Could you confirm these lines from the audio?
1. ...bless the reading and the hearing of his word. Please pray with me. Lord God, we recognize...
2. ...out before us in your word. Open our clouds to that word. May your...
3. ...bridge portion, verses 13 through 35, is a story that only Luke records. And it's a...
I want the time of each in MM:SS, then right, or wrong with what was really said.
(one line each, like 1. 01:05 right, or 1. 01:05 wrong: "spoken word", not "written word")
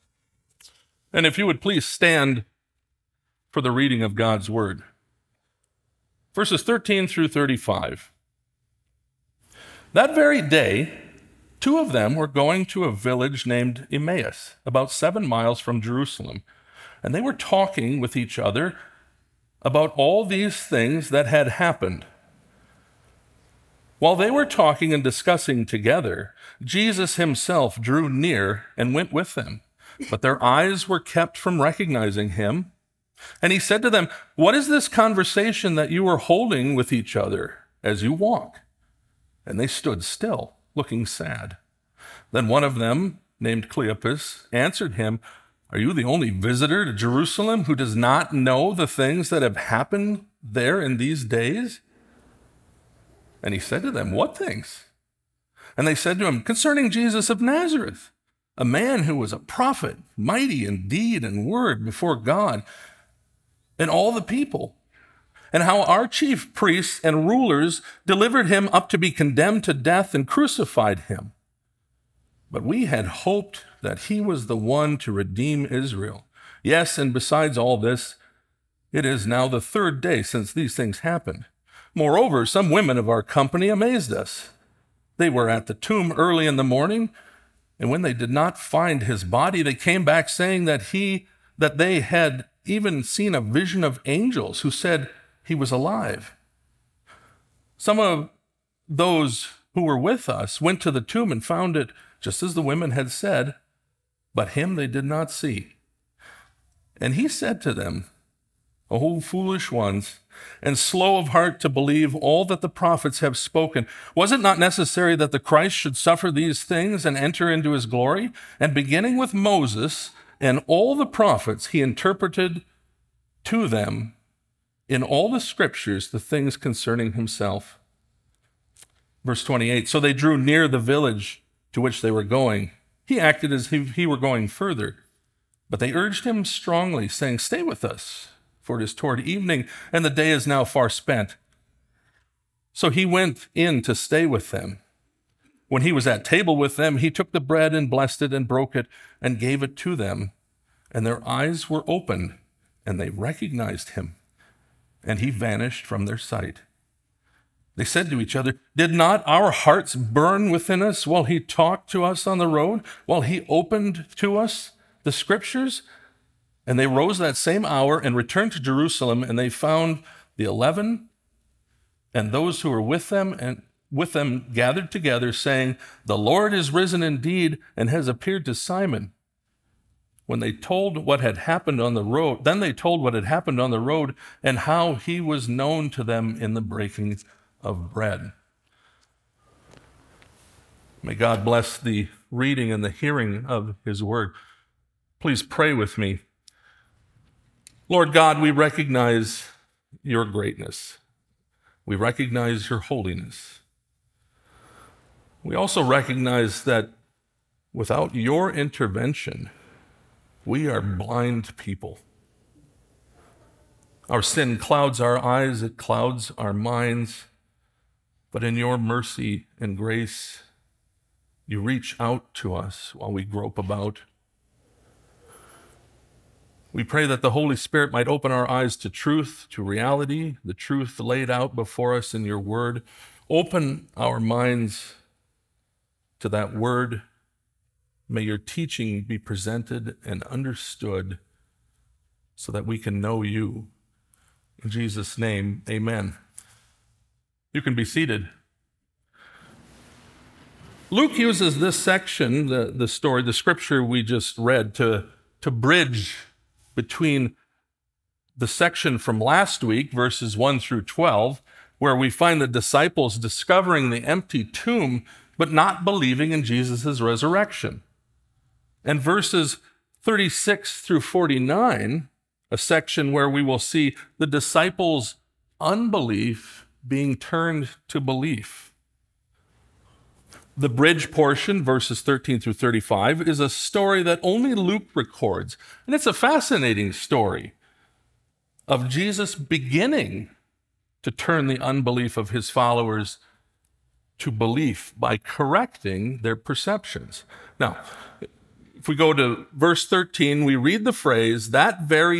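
1. 03:11 right
2. 03:51 wrong: "minds", not "clouds"
3. 04:40 right.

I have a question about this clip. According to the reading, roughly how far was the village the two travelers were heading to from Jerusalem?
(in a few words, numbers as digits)
7 miles.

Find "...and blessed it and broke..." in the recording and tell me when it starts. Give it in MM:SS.
02:27.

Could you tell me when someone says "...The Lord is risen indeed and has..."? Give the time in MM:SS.
02:56.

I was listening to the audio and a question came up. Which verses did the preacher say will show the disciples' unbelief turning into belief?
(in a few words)
36 through 49.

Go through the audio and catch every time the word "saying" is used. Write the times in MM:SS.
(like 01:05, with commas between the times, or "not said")
01:30, 02:17, 02:55.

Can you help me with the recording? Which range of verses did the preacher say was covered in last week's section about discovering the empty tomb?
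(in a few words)
1 through 12.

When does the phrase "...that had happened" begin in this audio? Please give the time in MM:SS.
00:21.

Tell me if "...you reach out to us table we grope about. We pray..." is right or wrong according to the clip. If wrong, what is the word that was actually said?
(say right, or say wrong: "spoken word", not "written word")
wrong: "while", not "table".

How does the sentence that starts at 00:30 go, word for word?
But their eyes were kept from recognizing him.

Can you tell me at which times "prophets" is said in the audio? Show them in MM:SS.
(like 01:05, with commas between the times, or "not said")
00:59, 01:52, 02:01.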